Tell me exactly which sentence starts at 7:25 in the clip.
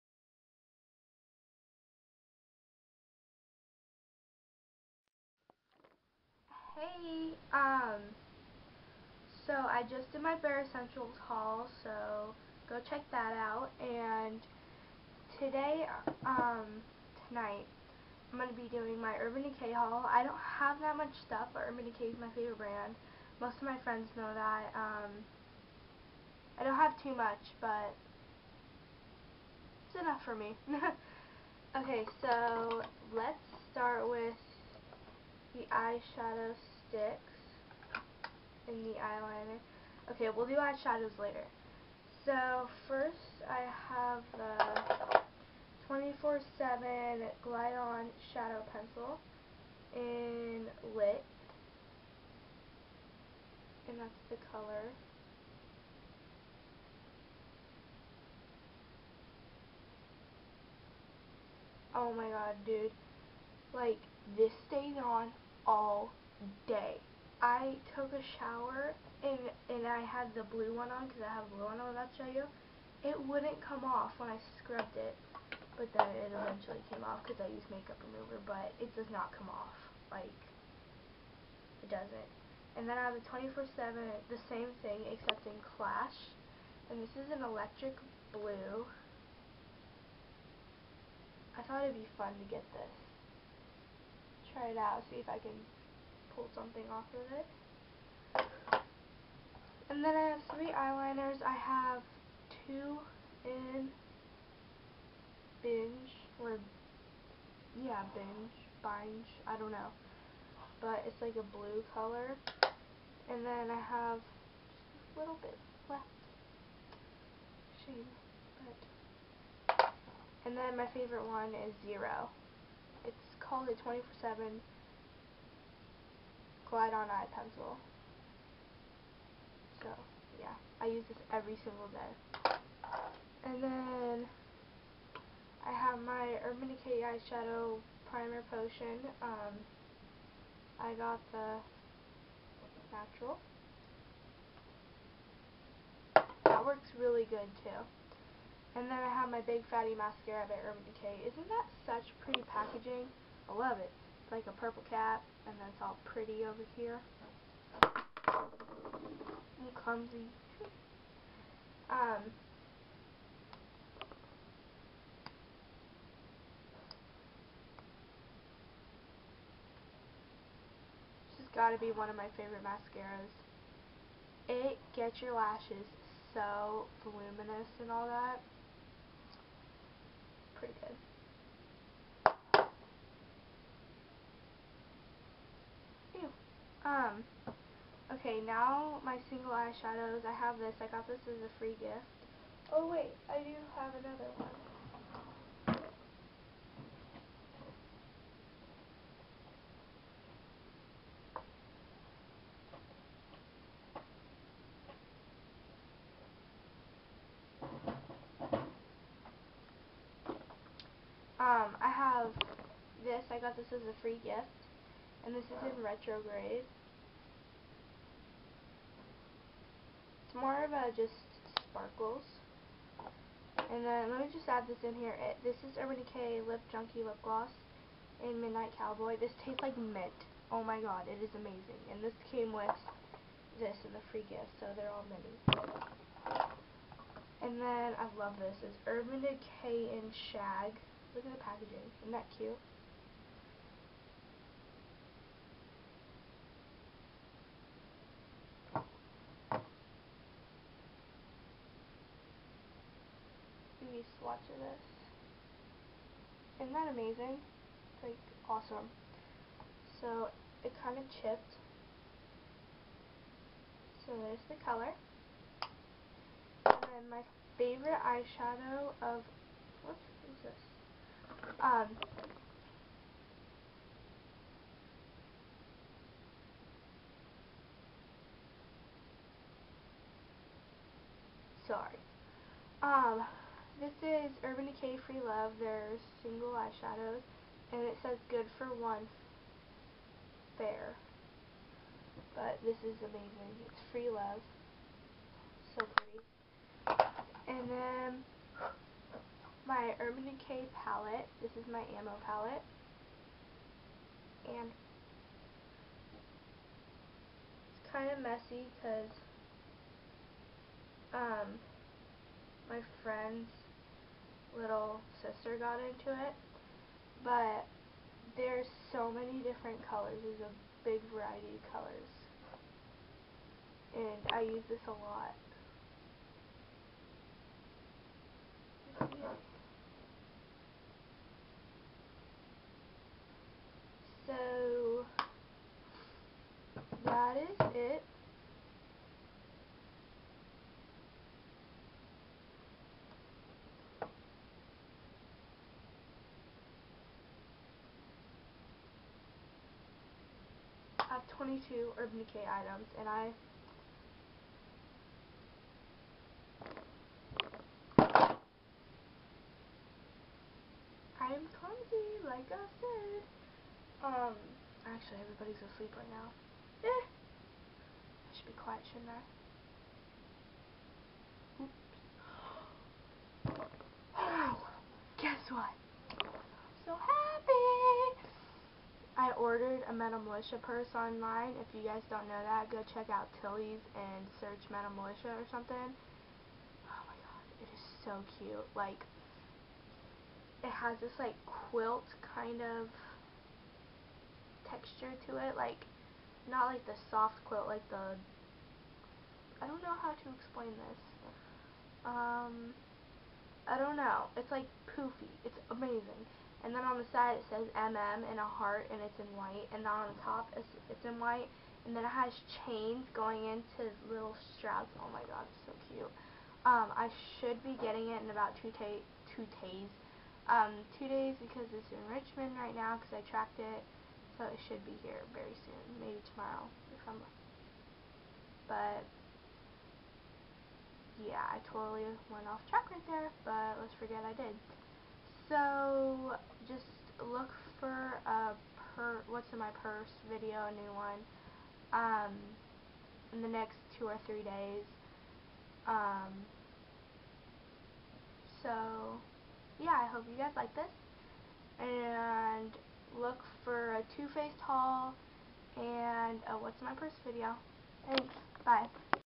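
Um, so yeah, I hope you guys like this.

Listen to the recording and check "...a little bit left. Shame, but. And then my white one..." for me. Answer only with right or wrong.
wrong.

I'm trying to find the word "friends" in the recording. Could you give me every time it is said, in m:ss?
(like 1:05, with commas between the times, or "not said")
0:23, 5:13.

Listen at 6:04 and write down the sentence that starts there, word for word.
Um, actually, everybody's asleep right now.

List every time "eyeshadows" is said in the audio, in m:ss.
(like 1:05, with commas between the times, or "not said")
0:35, 0:40, 2:17, 3:09, 4:28, 4:46.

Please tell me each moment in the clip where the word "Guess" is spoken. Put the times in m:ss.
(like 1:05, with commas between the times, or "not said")
6:15.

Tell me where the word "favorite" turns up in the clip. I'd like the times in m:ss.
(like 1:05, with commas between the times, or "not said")
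0:22, 2:00, 2:52, 4:27.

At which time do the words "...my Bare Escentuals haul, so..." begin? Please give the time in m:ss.
0:10.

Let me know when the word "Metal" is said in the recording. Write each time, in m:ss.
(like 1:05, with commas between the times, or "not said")
6:19, 6:24.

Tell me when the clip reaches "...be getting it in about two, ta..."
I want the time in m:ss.
6:57.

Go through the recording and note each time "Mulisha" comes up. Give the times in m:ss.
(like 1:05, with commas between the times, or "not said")
6:20, 6:24.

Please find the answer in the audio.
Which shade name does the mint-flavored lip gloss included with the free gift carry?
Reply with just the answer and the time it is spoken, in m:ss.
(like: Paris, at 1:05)
Midnight Cowboy, at 3:48.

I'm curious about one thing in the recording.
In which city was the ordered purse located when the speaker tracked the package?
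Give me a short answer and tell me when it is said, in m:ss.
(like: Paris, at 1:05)
Richmond, at 7:02.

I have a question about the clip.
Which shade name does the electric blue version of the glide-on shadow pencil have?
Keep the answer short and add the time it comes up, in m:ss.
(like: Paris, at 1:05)
Clash, at 1:25.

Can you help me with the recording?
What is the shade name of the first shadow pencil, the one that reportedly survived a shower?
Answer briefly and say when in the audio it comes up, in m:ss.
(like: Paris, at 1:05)
Lit, at 0:50.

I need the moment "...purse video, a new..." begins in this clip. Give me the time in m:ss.
7:19.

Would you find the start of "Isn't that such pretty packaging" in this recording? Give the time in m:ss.
2:31.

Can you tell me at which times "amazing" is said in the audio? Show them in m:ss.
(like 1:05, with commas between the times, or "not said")
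3:51, 4:16, 4:53, 6:45.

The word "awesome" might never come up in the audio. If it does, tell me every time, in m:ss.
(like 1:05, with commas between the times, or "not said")
4:18.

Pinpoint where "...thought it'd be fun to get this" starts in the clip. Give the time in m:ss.
1:31.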